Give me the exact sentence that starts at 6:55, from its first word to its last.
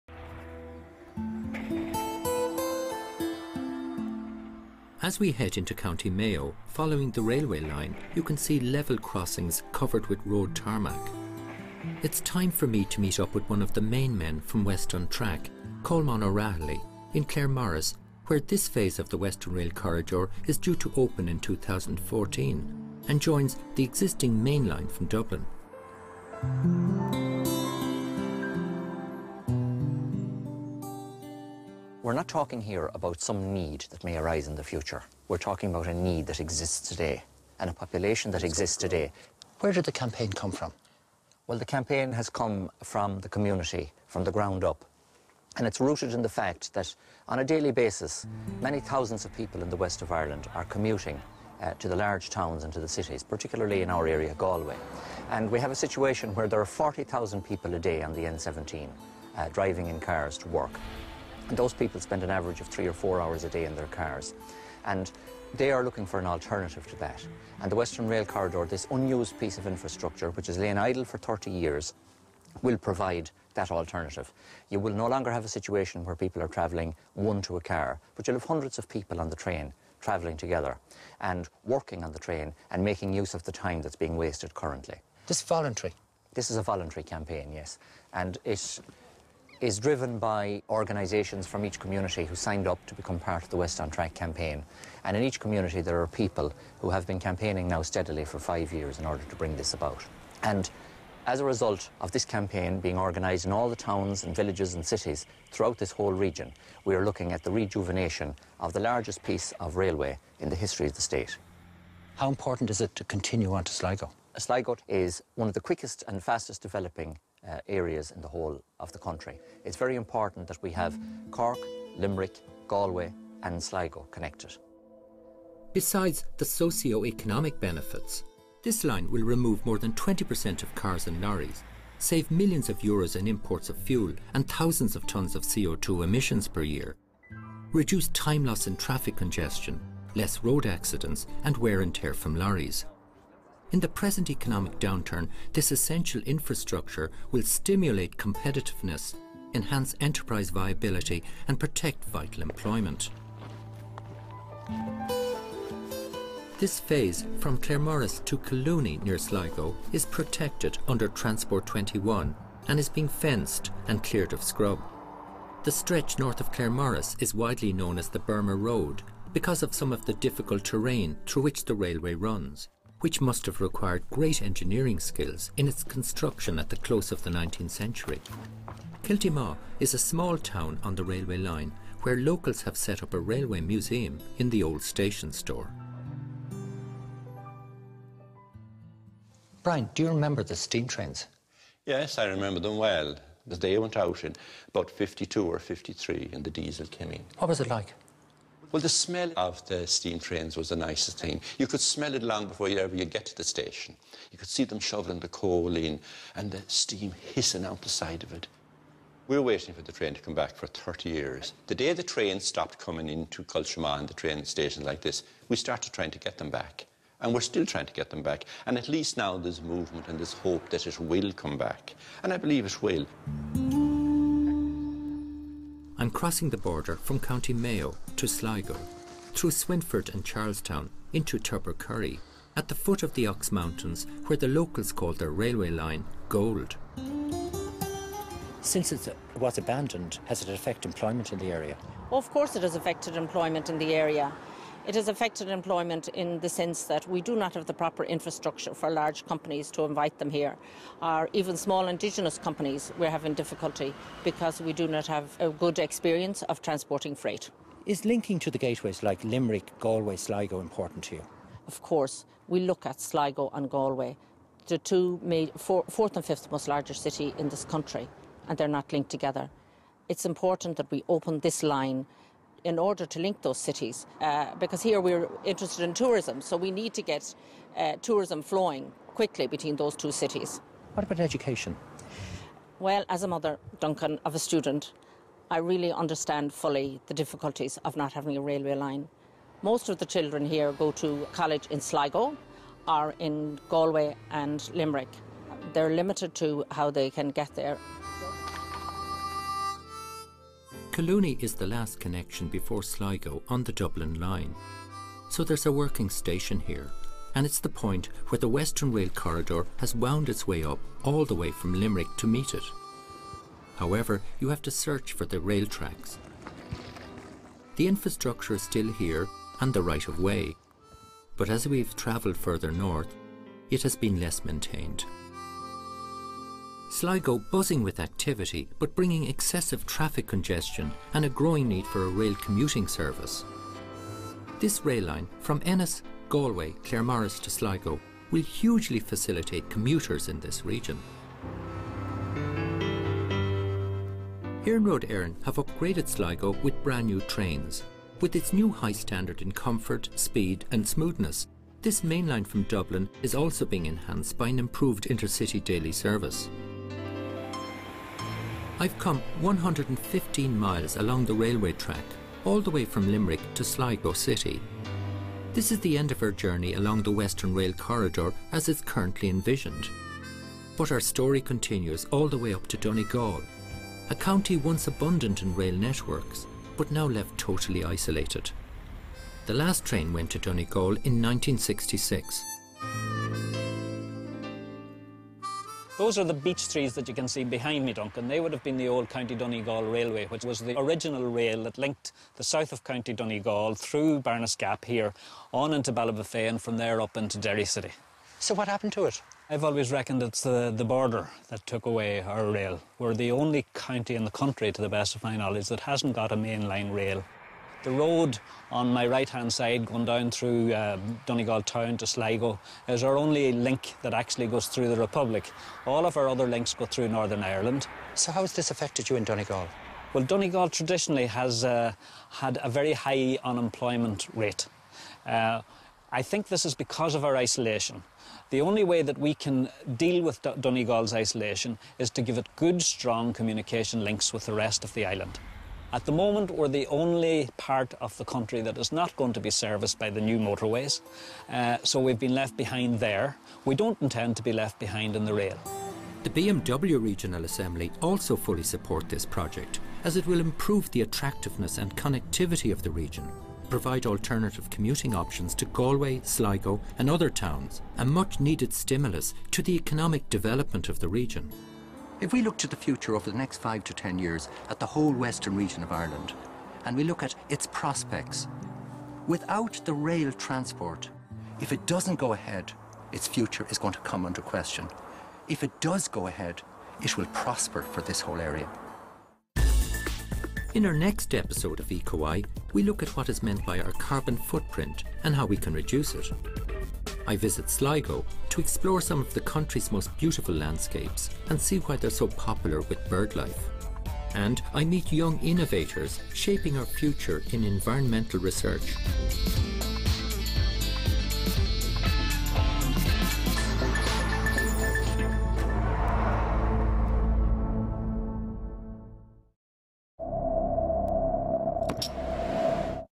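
All of our other links go through Northern Ireland.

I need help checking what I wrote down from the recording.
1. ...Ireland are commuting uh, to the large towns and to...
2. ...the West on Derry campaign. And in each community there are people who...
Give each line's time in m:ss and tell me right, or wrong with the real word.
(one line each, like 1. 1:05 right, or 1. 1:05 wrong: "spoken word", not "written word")
1. 0:50 right
2. 1:33 wrong: "Track", not "Derry".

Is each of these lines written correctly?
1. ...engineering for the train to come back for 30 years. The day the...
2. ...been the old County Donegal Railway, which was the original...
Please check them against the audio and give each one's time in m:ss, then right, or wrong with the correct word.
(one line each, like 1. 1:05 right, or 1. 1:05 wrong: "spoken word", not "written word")
1. 3:29 wrong: "waiting", not "engineering"
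2. 6:28 right.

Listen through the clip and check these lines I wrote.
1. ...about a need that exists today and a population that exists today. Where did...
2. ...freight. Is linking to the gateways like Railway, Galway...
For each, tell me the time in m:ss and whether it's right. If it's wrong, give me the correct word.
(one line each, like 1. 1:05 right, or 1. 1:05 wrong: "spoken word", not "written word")
1. 0:35 right
2. 4:17 wrong: "Limerick", not "Railway".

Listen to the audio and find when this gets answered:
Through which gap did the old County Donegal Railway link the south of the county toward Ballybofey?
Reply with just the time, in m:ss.
6:34.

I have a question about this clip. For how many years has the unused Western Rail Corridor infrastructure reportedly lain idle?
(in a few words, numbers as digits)
30 years.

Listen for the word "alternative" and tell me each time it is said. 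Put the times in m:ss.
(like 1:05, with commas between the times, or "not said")
1:06, 1:13, 7:34.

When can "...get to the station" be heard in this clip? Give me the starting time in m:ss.
3:23.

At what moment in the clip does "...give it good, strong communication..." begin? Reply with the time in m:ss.
7:12.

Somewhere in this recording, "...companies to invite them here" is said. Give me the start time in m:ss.
4:09.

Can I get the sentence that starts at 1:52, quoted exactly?
How important is it to continue on to Sligo?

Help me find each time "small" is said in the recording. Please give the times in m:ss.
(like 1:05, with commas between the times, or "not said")
2:59, 4:11.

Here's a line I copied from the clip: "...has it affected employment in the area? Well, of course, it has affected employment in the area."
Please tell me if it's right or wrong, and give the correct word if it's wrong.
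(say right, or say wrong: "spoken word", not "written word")
right.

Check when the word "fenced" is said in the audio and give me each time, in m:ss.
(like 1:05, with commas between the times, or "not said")
2:43.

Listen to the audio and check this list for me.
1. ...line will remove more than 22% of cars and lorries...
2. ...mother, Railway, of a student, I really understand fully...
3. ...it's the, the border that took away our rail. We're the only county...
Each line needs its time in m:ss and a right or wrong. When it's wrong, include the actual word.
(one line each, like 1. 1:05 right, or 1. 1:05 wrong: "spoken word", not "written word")
1. 2:08 wrong: "20", not "22"
2. 4:43 wrong: "Duncan", not "Railway"
3. 6:40 right.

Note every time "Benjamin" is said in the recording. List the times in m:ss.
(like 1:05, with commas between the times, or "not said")
not said.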